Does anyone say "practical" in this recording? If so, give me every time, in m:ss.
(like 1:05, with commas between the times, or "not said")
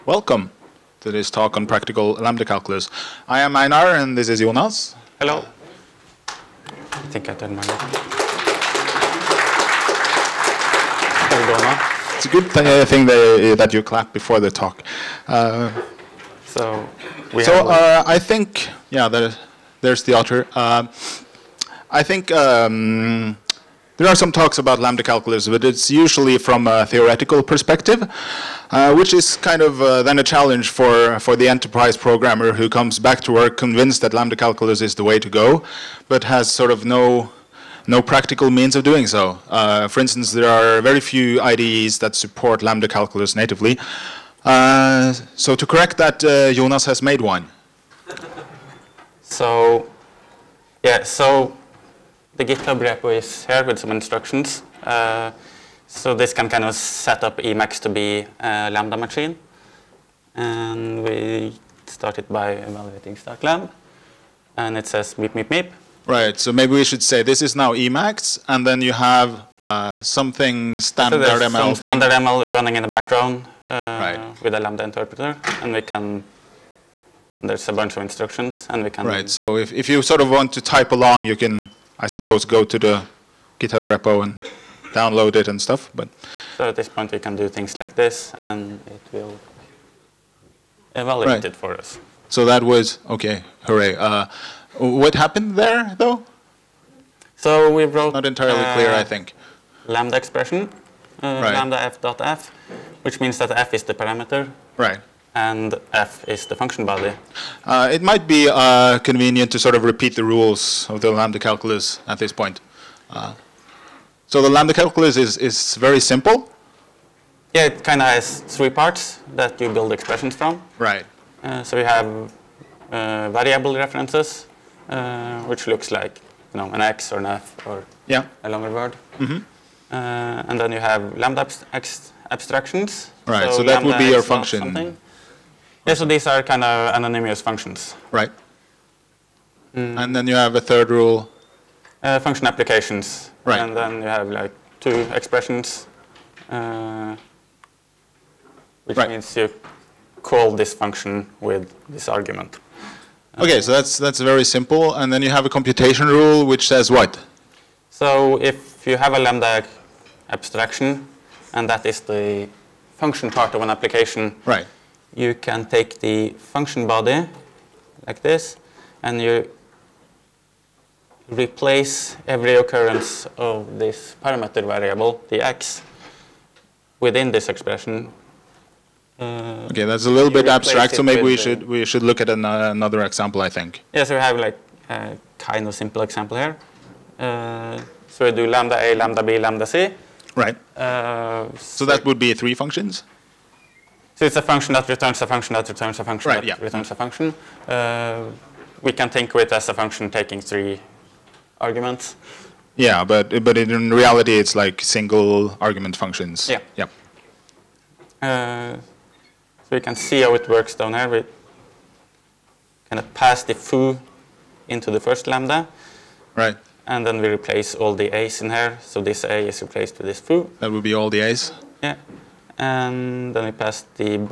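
0:01, 0:38.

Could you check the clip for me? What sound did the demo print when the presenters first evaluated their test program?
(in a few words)
meep, meep, meep.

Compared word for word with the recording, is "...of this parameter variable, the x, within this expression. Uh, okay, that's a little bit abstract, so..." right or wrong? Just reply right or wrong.
right.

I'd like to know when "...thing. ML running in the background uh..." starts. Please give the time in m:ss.
1:12.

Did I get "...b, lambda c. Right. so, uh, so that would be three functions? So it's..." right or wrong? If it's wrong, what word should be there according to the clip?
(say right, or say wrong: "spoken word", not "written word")
right.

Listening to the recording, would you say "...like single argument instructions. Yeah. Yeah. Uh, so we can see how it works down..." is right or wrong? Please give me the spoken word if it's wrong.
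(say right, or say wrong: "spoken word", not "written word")
wrong: "functions", not "instructions".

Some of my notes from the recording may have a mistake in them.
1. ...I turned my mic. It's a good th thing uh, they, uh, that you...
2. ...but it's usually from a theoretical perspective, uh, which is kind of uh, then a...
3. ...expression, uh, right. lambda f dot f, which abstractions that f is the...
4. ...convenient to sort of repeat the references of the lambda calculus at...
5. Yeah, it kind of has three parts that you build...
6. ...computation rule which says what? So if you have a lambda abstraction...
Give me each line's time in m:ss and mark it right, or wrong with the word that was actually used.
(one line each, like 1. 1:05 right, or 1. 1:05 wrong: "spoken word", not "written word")
1. 0:07 right
2. 0:25 right
3. 1:40 wrong: "means", not "abstractions"
4. 1:48 wrong: "rules", not "references"
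5. 1:57 right
6. 2:35 right.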